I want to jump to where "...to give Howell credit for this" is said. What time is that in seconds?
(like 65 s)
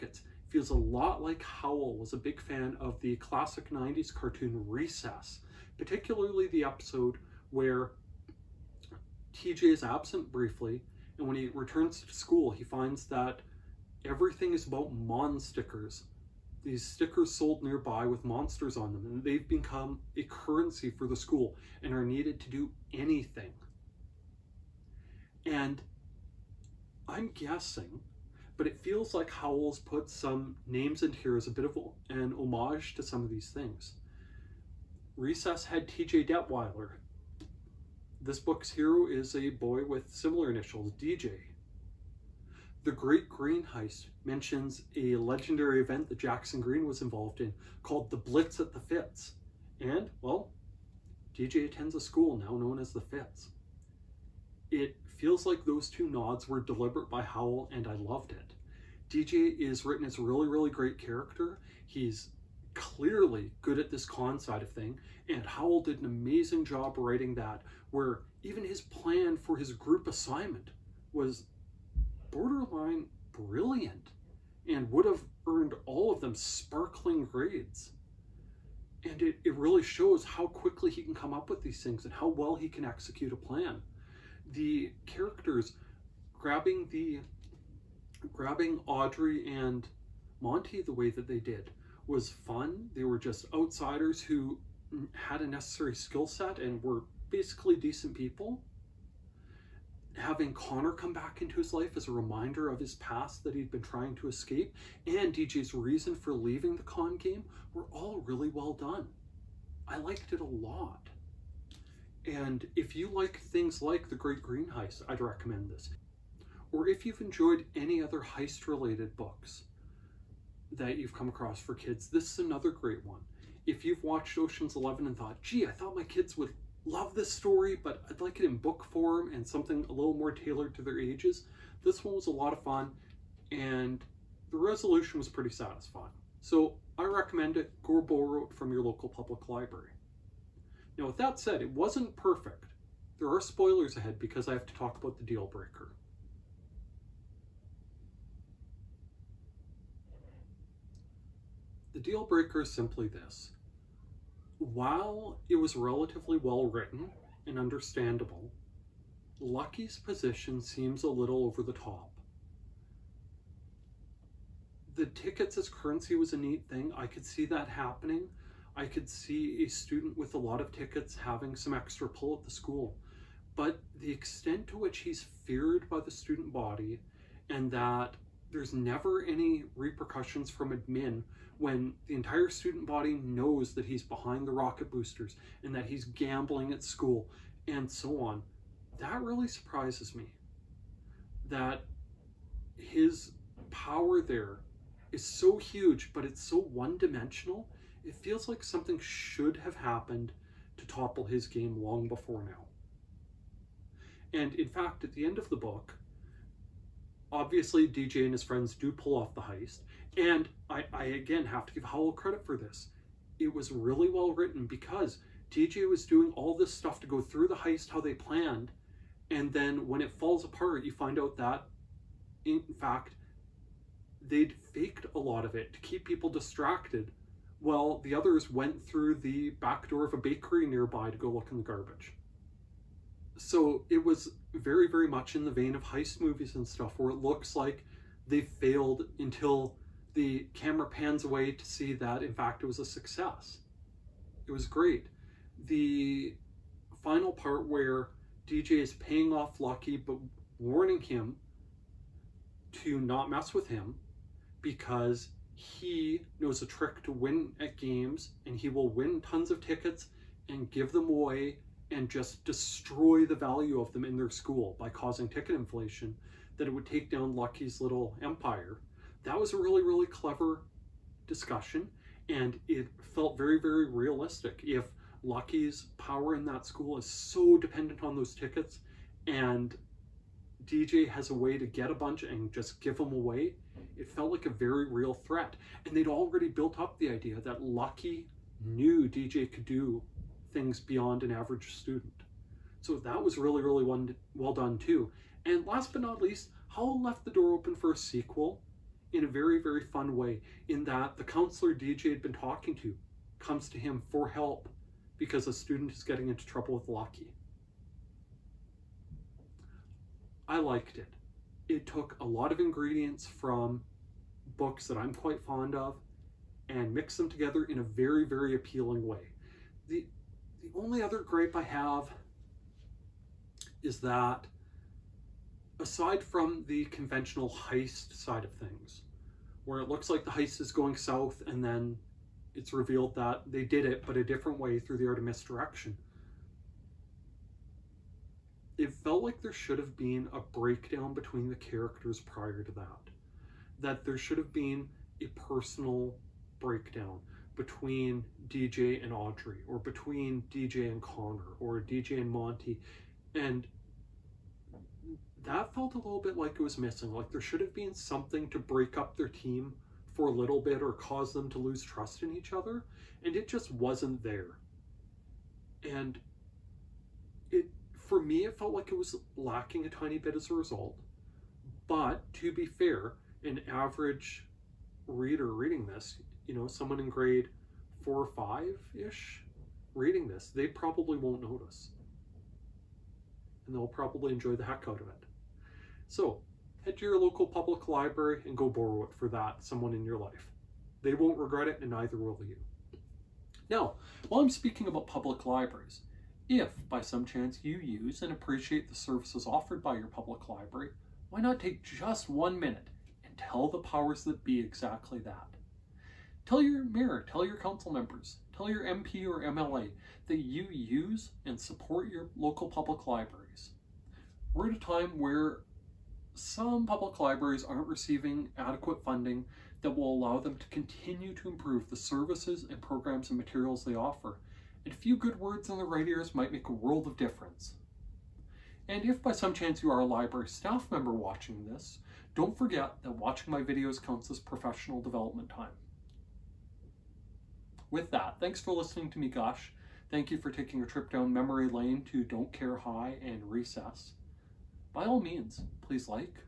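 211 s.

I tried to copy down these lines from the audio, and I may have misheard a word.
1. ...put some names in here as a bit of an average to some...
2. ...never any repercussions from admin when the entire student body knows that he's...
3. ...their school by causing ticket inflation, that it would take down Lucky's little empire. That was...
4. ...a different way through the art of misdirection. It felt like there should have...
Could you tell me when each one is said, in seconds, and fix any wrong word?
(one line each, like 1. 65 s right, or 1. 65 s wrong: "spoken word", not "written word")
1. 29 s wrong: "homage", not "average"
2. 178 s right
3. 264 s right
4. 334 s right.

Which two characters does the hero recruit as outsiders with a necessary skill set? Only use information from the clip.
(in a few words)
Audrey and Monty.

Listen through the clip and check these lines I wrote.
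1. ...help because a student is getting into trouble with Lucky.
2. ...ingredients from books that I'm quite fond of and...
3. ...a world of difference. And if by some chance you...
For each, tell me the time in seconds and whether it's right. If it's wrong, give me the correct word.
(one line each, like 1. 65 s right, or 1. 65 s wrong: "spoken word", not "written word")
1. 304 s right
2. 312 s right
3. 426 s right.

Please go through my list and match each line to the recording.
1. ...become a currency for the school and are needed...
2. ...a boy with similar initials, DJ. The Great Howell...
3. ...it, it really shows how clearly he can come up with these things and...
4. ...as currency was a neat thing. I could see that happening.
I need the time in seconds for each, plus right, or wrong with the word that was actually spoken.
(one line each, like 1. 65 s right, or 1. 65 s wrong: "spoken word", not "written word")
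1. 19 s right
2. 39 s wrong: "Greene", not "Howell"
3. 79 s wrong: "quickly", not "clearly"
4. 165 s right.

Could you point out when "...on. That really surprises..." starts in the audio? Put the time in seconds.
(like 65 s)
188 s.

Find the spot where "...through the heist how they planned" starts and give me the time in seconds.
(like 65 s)
217 s.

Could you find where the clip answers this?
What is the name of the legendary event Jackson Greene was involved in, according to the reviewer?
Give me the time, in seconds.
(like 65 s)
48 s.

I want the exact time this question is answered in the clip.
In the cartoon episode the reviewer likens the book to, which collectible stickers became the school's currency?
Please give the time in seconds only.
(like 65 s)
14 s.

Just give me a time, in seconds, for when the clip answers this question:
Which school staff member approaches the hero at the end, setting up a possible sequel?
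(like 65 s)
301 s.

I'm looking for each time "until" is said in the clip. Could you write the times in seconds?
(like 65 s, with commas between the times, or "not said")
239 s.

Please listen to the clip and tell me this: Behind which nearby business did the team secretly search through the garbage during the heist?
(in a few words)
A bakery.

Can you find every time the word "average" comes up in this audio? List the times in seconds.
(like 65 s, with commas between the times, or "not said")
291 s, 373 s.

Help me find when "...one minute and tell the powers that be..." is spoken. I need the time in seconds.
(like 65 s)
402 s.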